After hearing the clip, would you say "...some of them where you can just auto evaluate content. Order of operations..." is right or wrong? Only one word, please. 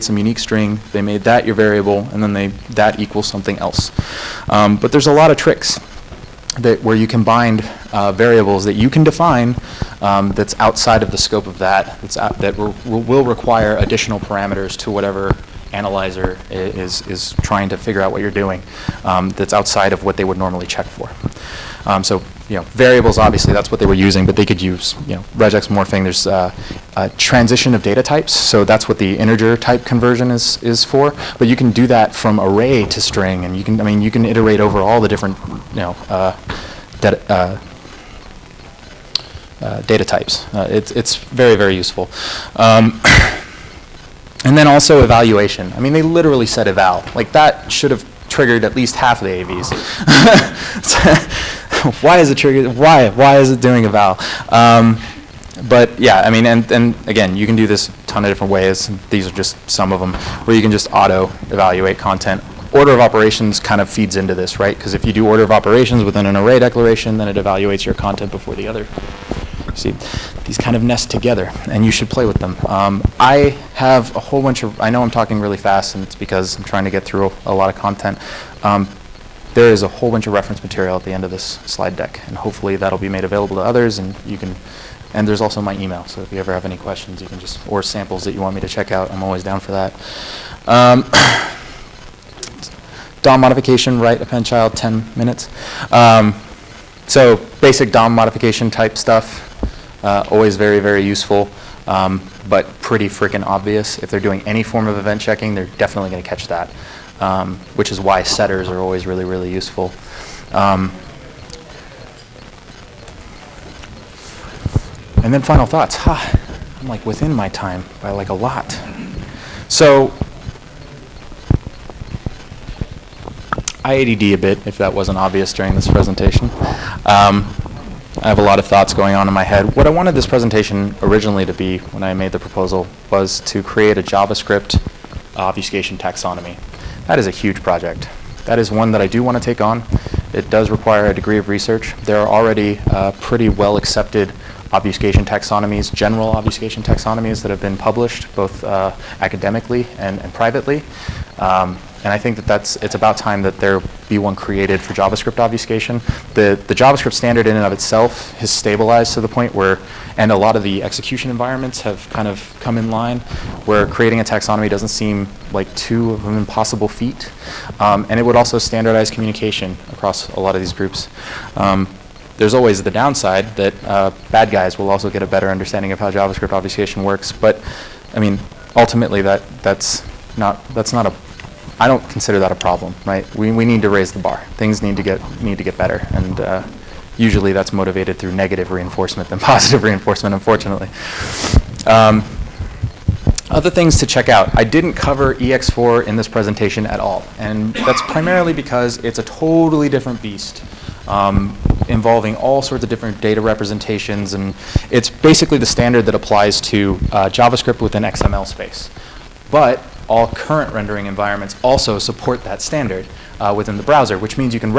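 right.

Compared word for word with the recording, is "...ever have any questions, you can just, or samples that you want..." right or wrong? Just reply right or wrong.
right.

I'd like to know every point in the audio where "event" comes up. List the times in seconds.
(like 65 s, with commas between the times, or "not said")
104 s.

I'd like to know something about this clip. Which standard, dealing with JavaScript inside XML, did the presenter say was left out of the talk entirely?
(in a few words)
EX4.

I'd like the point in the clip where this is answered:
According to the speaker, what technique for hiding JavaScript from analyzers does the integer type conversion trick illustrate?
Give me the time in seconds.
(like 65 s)
27 s.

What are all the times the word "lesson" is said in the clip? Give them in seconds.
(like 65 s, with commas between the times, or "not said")
not said.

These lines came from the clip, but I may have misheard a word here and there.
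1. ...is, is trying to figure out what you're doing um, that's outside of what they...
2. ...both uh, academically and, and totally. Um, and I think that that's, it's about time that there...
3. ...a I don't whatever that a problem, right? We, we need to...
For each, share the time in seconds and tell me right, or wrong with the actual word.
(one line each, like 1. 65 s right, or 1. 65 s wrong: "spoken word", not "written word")
1. 16 s right
2. 148 s wrong: "privately", not "totally"
3. 181 s wrong: "consider", not "whatever".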